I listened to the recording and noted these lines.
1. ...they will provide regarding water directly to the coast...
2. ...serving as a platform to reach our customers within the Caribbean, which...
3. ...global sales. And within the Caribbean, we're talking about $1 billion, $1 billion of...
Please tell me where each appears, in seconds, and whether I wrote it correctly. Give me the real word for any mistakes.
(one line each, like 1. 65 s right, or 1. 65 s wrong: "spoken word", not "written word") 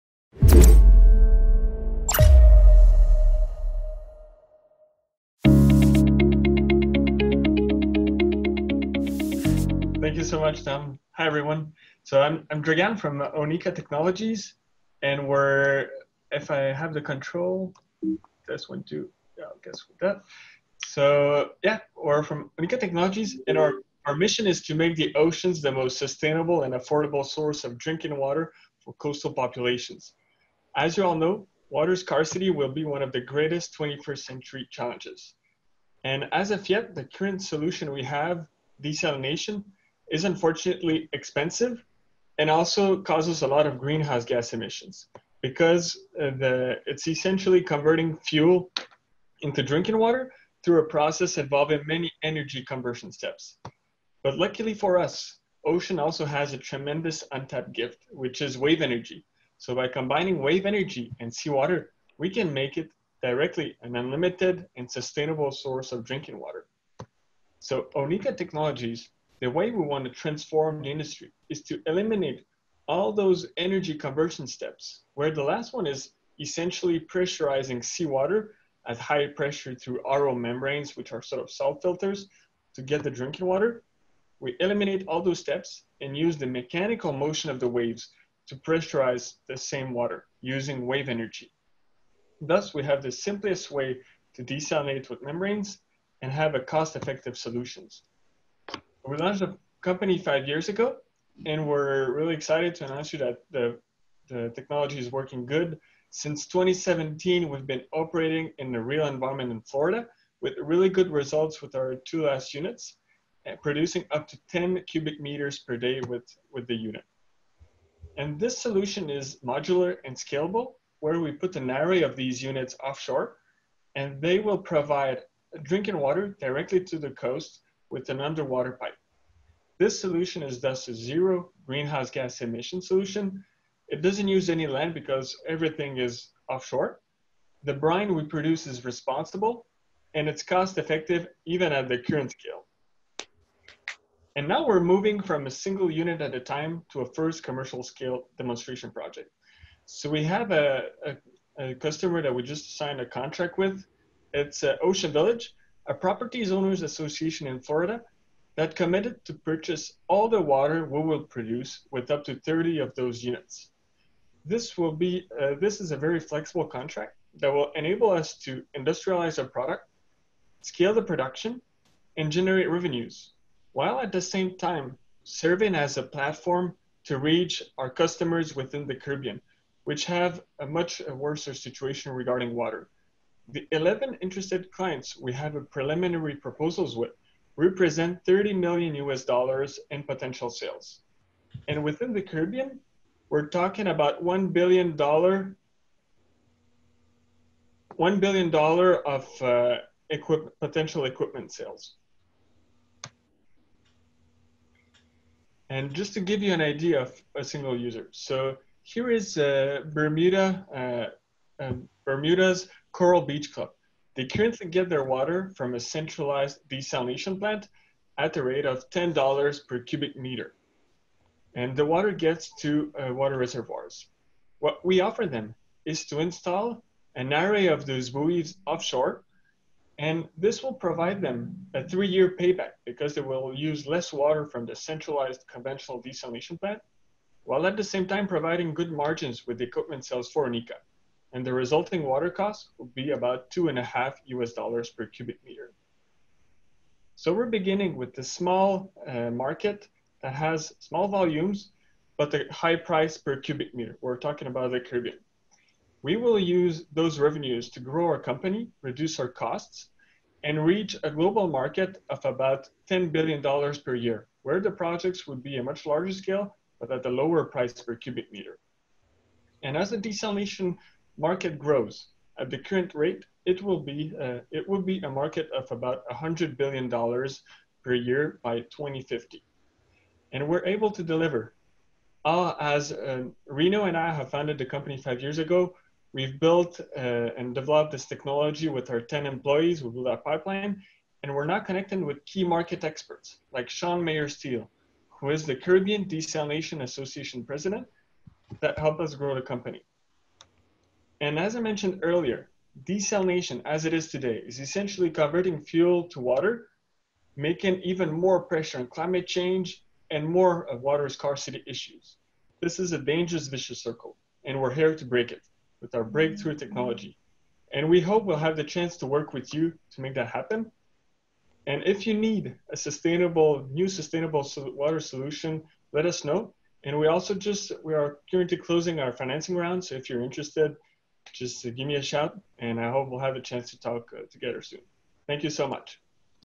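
1. 124 s wrong: "drinking", not "regarding"
2. 175 s right
3. 190 s wrong: "potential", not "global".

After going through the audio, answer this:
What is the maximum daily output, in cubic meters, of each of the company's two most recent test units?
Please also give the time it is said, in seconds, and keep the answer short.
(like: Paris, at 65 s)
10 cubic meters, at 114 s.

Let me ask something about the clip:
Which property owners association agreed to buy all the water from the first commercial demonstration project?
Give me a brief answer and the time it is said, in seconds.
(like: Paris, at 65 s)
Ocean Village, at 154 s.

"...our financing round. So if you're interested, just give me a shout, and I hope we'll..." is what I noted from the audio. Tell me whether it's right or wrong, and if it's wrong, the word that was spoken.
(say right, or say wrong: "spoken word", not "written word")
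right.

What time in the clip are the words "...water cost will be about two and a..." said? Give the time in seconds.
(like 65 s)
242 s.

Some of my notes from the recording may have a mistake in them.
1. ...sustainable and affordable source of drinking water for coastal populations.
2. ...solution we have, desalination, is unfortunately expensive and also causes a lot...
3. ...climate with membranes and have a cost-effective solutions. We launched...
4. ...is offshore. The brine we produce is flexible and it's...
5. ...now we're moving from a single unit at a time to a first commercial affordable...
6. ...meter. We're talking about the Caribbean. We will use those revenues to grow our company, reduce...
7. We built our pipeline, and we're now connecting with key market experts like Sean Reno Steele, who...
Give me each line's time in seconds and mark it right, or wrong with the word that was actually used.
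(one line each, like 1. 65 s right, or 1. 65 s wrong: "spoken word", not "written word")
1. 25 s right
2. 37 s right
3. 94 s wrong: "desalinate", not "climate"
4. 135 s wrong: "responsible", not "flexible"
5. 144 s wrong: "scale", not "affordable"
6. 253 s right
7. 289 s wrong: "Mayer", not "Reno".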